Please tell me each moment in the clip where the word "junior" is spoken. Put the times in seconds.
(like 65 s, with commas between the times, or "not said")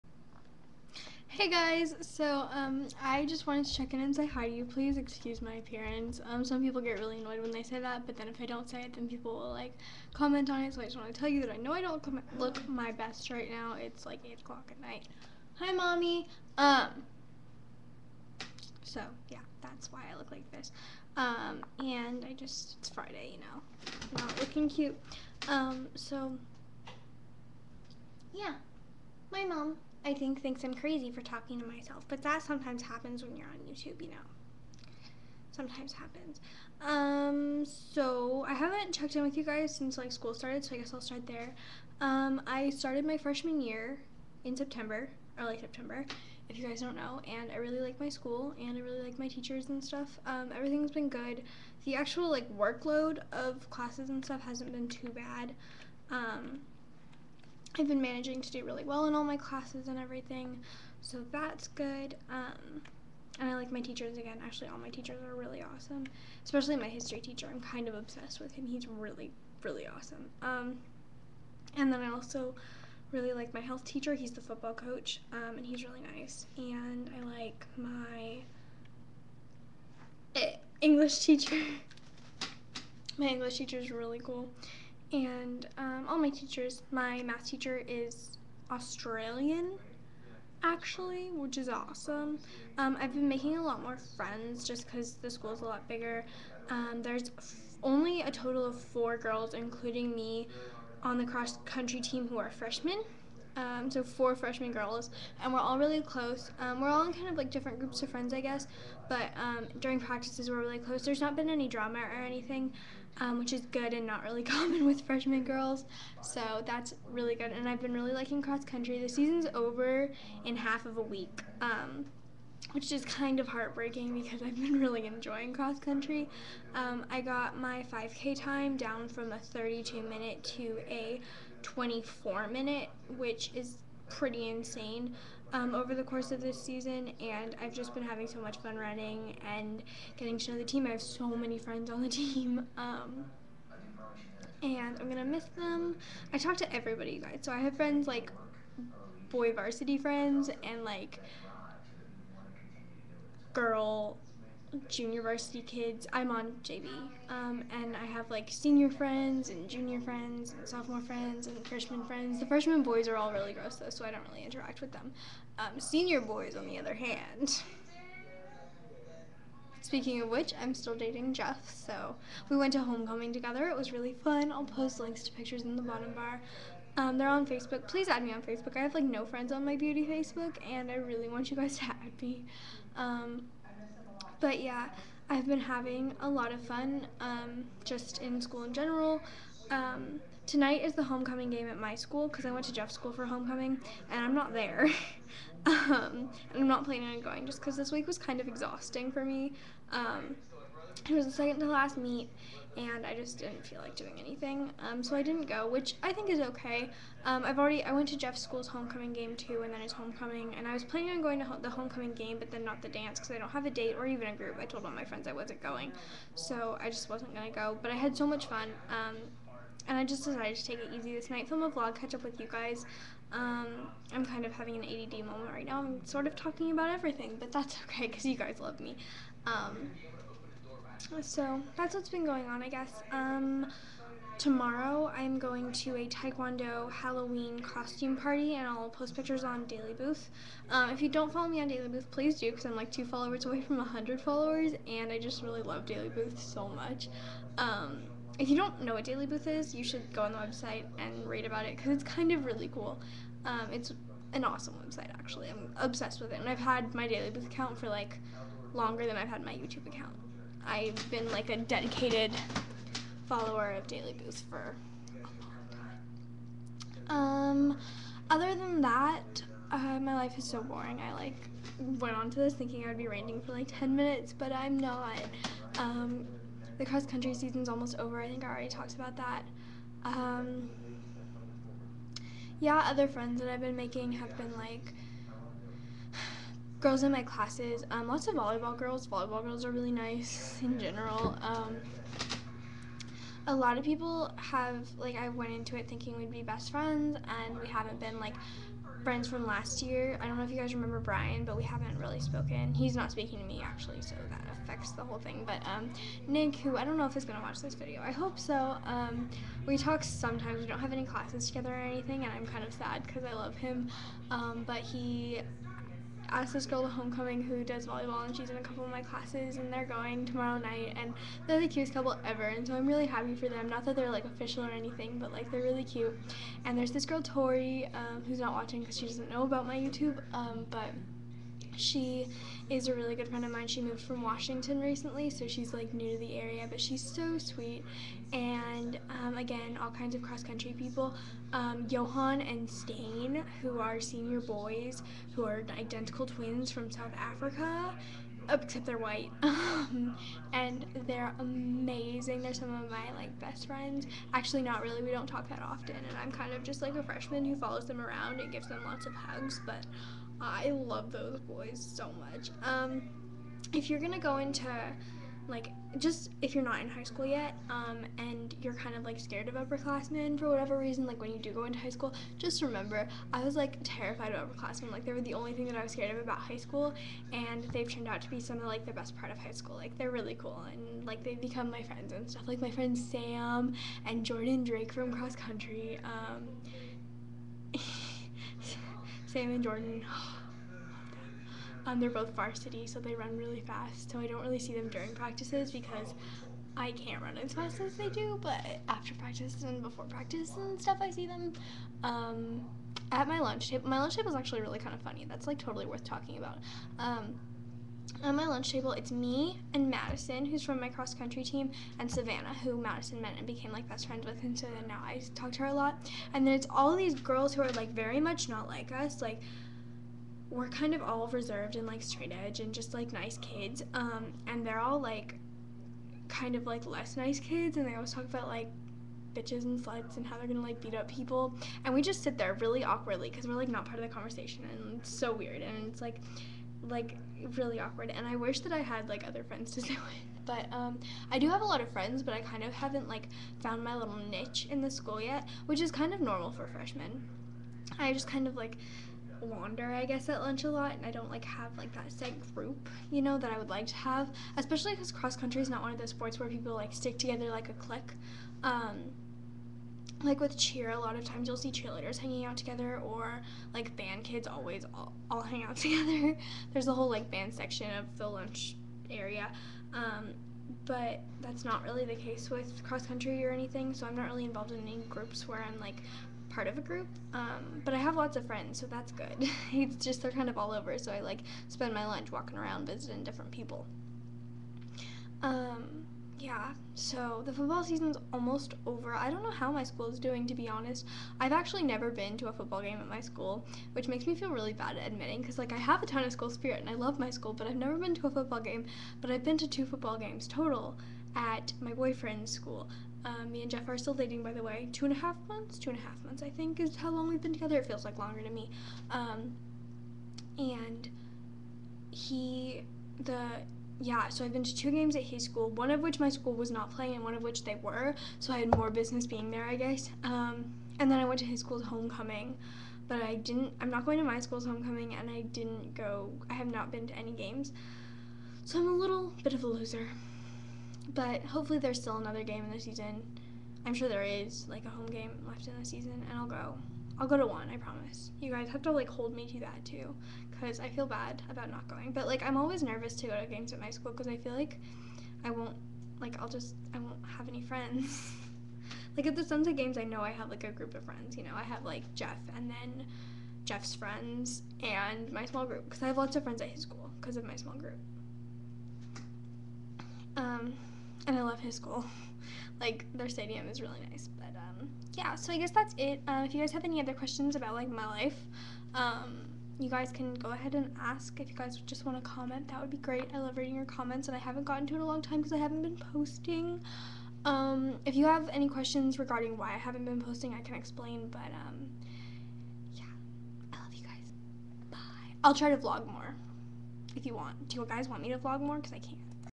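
154 s, 159 s.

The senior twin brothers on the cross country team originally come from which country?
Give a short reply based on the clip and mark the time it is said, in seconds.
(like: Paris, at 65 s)
South Africa, at 346 s.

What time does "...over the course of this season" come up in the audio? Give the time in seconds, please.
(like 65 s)
135 s.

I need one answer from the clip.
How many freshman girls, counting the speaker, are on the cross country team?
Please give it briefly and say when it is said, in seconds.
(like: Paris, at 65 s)
4, at 98 s.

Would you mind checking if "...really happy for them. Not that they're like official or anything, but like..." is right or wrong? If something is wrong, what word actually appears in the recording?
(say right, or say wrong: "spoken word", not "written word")
right.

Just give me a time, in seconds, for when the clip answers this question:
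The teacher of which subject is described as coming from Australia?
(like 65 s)
86 s.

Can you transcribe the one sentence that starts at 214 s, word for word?
I told all my friends I wasn't going, so I just wasn't gonna go.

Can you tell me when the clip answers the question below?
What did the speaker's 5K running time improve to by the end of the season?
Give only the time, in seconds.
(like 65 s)
131 s.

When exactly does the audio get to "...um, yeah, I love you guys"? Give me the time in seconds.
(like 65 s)
581 s.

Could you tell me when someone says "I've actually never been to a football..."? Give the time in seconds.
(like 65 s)
491 s.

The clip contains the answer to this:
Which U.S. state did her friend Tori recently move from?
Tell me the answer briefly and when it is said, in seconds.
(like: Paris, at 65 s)
Washington, at 334 s.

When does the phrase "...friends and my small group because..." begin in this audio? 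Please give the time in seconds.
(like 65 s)
553 s.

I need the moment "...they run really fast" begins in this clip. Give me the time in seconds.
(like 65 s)
392 s.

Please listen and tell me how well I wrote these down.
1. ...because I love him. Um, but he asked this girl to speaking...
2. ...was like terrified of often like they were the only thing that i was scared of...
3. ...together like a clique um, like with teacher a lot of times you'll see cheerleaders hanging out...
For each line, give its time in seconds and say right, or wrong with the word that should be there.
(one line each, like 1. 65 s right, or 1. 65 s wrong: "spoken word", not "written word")
1. 313 s wrong: "homecoming", not "speaking"
2. 373 s wrong: "upperclassmen", not "often"
3. 457 s wrong: "cheer", not "teacher".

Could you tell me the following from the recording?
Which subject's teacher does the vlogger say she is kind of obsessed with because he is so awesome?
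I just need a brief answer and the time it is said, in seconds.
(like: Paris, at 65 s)
History, at 66 s.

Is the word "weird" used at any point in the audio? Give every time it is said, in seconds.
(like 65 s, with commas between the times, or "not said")
435 s.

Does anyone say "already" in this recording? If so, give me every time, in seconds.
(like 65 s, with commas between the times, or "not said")
207 s, 278 s.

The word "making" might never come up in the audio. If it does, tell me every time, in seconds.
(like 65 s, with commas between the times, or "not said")
93 s, 283 s.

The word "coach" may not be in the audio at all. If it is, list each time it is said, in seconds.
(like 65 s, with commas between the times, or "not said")
74 s.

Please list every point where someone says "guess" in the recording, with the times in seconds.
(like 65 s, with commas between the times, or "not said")
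40 s, 108 s, 232 s, 450 s, 519 s, 565 s.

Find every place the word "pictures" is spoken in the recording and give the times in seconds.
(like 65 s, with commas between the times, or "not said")
175 s, 239 s.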